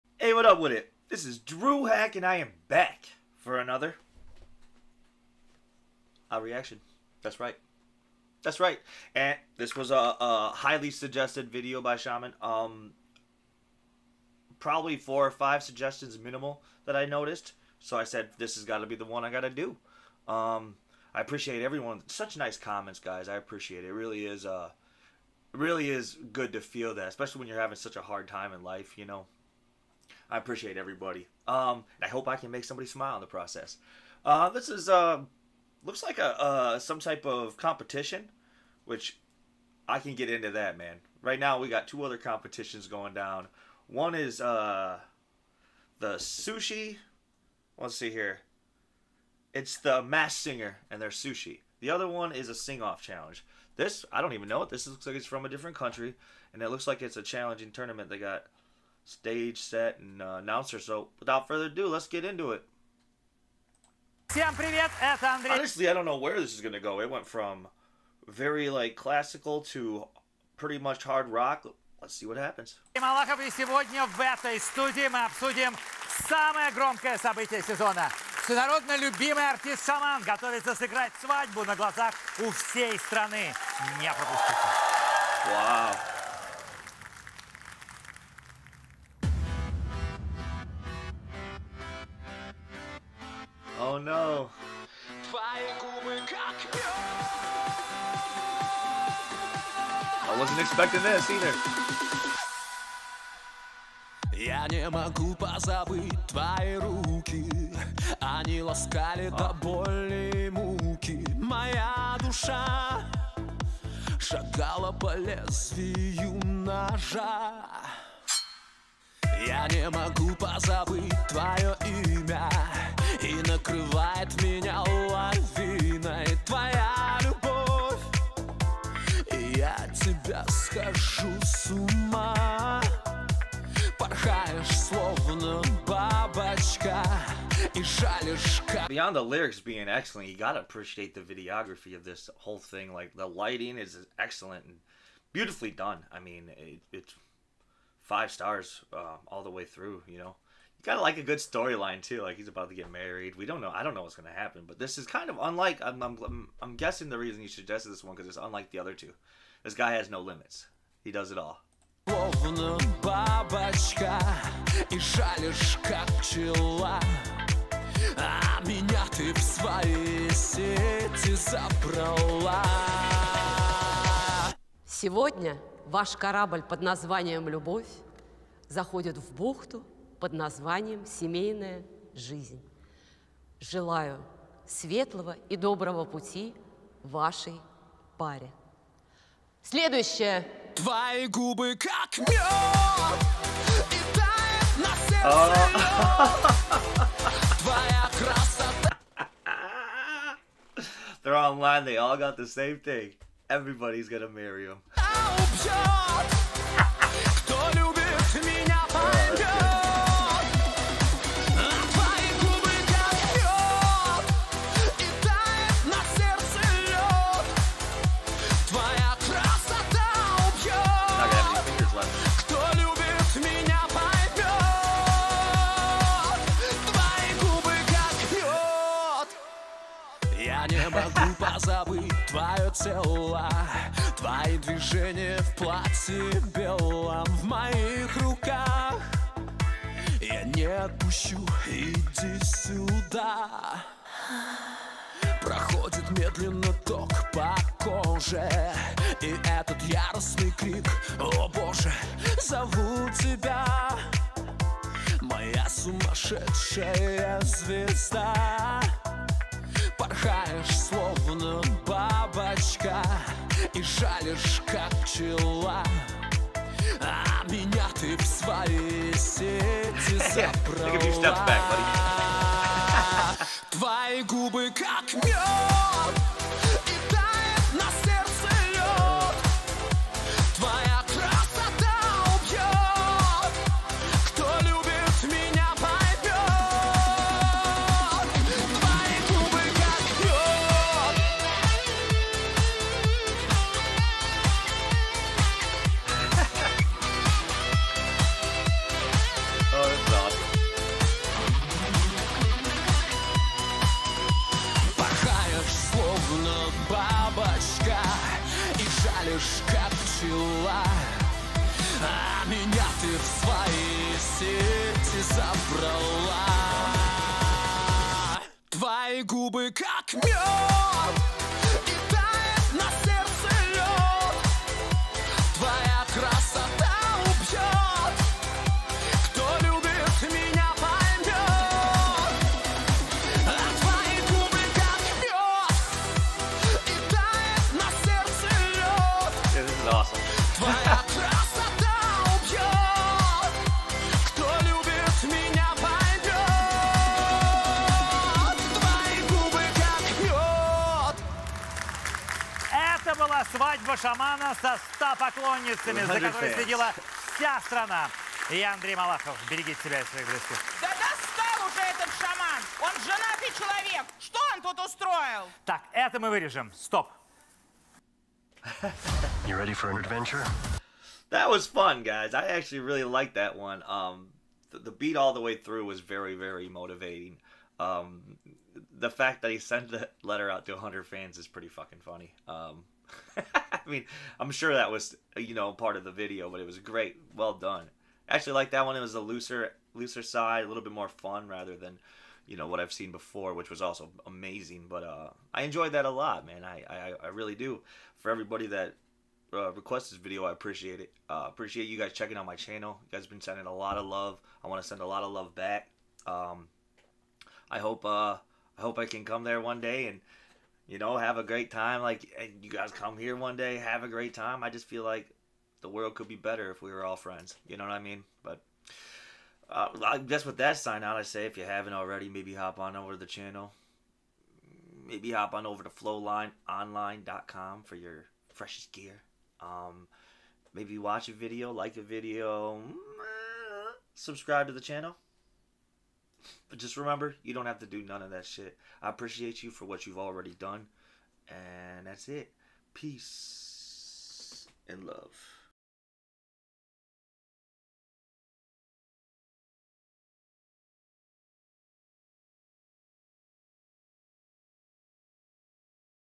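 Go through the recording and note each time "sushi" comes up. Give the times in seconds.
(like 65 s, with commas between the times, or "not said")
46 s, 51 s.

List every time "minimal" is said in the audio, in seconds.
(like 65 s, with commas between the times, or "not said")
16 s.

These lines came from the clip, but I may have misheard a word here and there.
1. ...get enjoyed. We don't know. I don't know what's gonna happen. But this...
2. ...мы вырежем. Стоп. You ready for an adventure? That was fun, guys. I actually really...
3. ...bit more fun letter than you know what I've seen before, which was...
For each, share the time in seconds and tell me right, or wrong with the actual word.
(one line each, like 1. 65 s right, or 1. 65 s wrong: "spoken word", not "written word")
1. 152 s wrong: "married", not "enjoyed"
2. 366 s right
3. 390 s wrong: "rather", not "letter".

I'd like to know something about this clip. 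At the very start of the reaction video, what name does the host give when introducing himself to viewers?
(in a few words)
Dru Hak.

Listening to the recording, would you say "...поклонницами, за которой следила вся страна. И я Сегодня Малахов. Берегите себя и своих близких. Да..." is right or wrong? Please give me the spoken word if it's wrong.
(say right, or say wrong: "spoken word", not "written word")
wrong: "Андрей", not "Сегодня".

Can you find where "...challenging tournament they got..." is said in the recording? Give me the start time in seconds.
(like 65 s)
57 s.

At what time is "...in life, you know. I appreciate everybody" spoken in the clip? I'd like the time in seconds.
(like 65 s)
28 s.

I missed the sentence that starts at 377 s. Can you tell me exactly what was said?
Um, the fact that he sent the letter out to 100 fans is pretty fucking funny.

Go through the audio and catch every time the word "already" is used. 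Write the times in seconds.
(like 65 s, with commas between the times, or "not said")
421 s, 440 s.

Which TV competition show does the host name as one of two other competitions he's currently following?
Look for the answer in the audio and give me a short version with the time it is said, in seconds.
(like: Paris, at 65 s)
The Masked Singer, at 49 s.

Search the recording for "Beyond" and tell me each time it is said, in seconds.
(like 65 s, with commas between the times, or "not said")
138 s.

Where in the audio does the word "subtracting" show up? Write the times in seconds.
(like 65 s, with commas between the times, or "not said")
not said.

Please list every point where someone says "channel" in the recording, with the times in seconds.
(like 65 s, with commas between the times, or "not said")
402 s, 423 s, 434 s.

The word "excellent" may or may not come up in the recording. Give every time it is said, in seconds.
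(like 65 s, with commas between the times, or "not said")
139 s, 144 s.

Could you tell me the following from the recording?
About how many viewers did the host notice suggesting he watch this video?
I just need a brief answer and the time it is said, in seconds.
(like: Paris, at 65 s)
4 or 5, at 14 s.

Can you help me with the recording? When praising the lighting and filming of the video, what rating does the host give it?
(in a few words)
5 stars.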